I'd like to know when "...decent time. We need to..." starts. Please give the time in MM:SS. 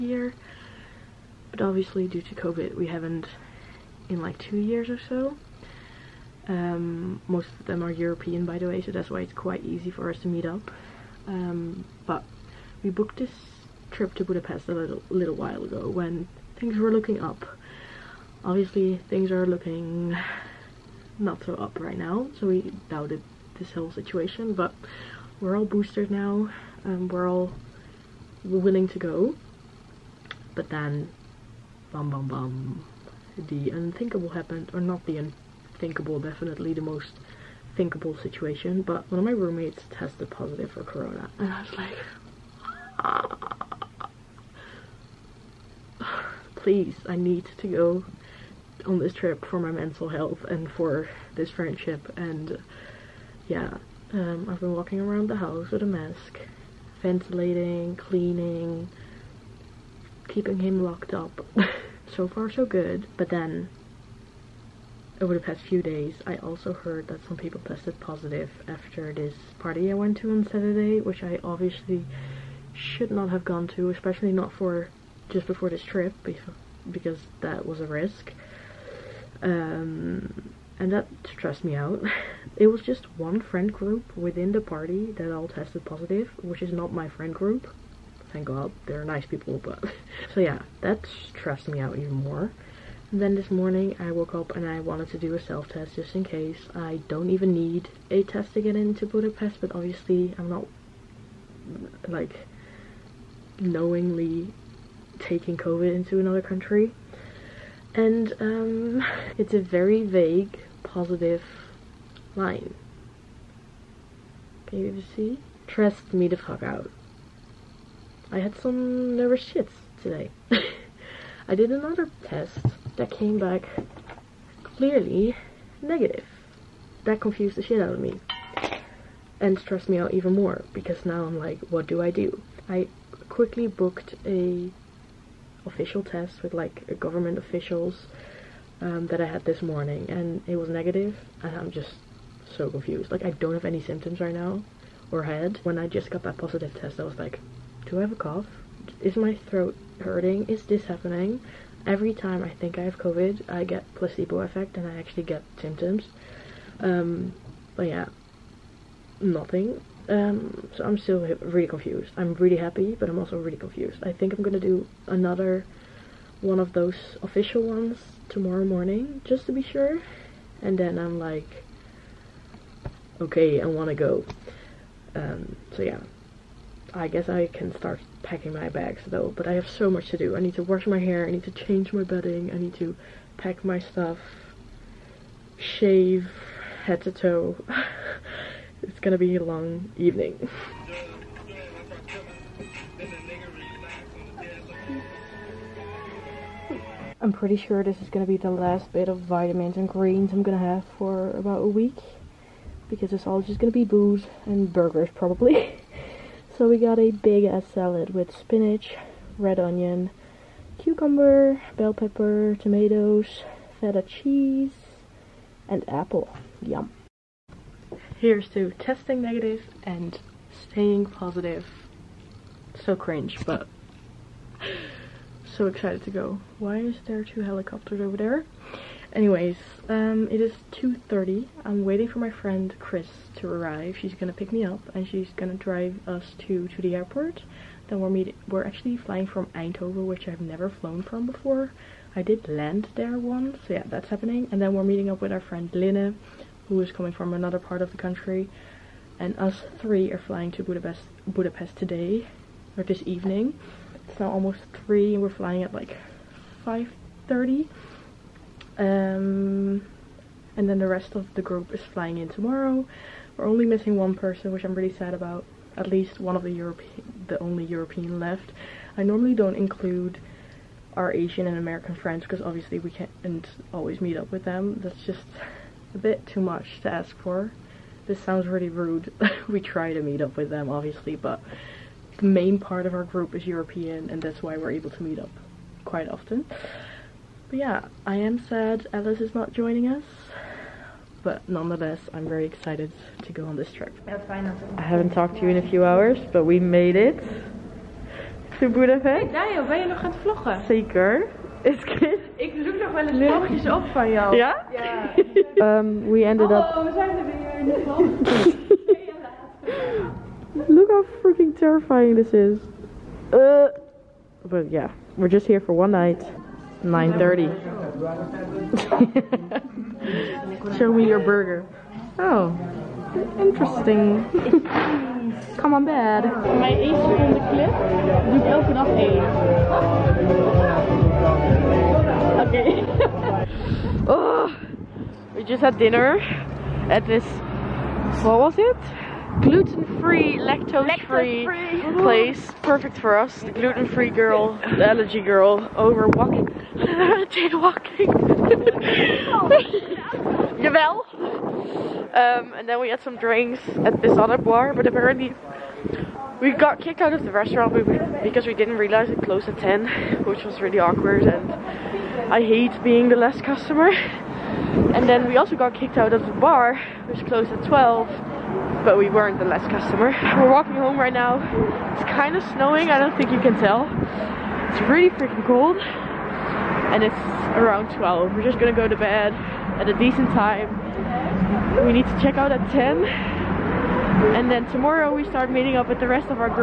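06:19.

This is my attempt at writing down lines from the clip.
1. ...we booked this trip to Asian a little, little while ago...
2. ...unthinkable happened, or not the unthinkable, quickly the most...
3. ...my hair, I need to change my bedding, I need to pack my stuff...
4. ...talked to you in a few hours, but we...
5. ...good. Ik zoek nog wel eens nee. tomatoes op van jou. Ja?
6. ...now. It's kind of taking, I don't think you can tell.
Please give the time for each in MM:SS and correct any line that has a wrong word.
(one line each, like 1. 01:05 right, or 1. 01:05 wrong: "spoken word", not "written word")
1. 00:12 wrong: "Budapest", not "Asian"
2. 00:33 wrong: "definitely", not "quickly"
3. 03:00 right
4. 04:55 right
5. 05:01 wrong: "vlogjes", not "tomatoes"
6. 06:11 wrong: "snowing", not "taking".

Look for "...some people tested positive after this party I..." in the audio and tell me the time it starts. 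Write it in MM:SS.
01:07.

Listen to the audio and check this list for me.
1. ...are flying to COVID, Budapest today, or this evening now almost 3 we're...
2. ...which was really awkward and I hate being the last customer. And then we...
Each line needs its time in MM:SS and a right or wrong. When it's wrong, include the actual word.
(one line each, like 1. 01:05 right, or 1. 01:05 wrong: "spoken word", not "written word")
1. 04:10 wrong: "Budapest", not "COVID"
2. 06:00 right.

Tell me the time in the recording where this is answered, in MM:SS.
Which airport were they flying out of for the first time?
03:59.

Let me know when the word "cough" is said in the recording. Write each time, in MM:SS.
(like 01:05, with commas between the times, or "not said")
02:28.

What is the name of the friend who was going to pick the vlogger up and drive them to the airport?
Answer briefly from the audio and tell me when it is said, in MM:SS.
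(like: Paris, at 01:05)
Chris, at 03:52.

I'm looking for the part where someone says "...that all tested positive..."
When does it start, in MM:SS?
01:25.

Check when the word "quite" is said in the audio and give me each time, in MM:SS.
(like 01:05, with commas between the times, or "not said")
00:09, 04:45.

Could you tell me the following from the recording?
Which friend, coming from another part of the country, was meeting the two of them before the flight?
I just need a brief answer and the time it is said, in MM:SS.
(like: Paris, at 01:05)
Linne, at 04:05.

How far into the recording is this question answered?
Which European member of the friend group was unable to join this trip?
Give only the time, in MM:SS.
04:48.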